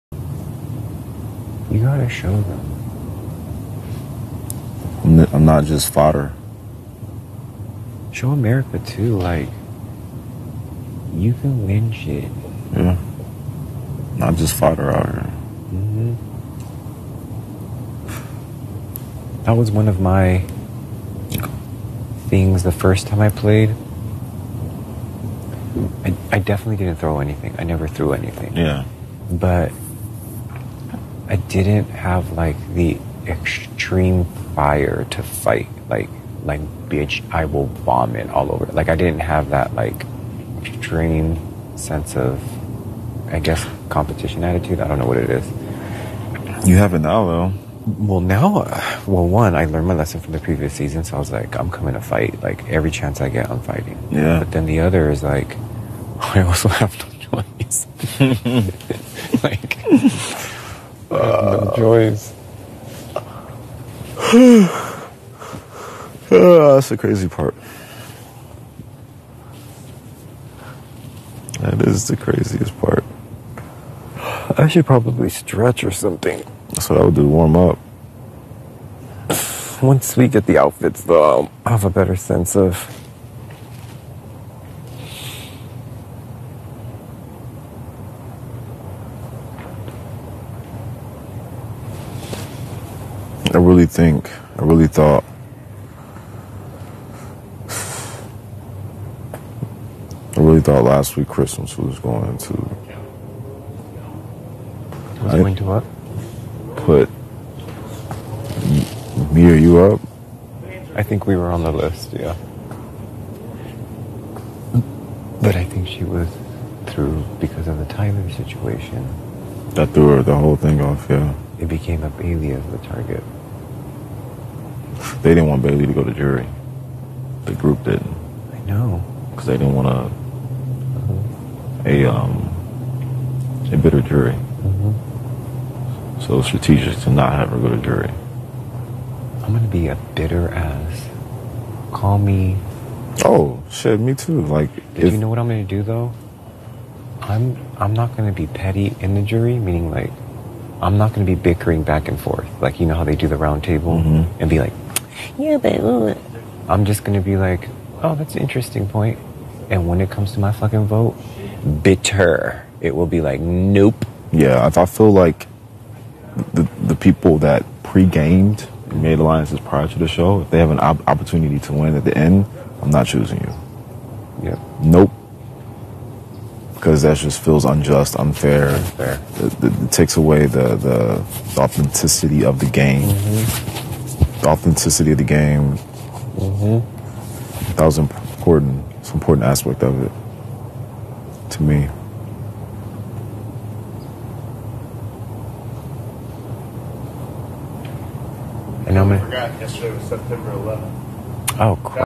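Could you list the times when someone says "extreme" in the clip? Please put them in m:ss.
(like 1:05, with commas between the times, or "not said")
0:33, 0:40.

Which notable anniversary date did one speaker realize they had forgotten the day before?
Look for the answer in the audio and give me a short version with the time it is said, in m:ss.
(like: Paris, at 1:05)
September 11th, at 3:20.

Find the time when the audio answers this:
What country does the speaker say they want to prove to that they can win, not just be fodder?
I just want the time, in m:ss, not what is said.
0:08.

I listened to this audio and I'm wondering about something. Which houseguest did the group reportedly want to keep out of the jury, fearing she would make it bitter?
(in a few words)
Bayleigh.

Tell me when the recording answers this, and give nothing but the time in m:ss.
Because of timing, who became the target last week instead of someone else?
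1:41.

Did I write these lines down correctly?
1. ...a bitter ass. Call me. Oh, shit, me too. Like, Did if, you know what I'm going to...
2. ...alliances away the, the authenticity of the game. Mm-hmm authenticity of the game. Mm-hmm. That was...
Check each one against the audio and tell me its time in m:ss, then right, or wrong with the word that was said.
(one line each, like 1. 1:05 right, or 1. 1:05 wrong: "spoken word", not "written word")
1. 2:19 right
2. 2:59 wrong: "takes", not "alliances".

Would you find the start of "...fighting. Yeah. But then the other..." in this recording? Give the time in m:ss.
0:53.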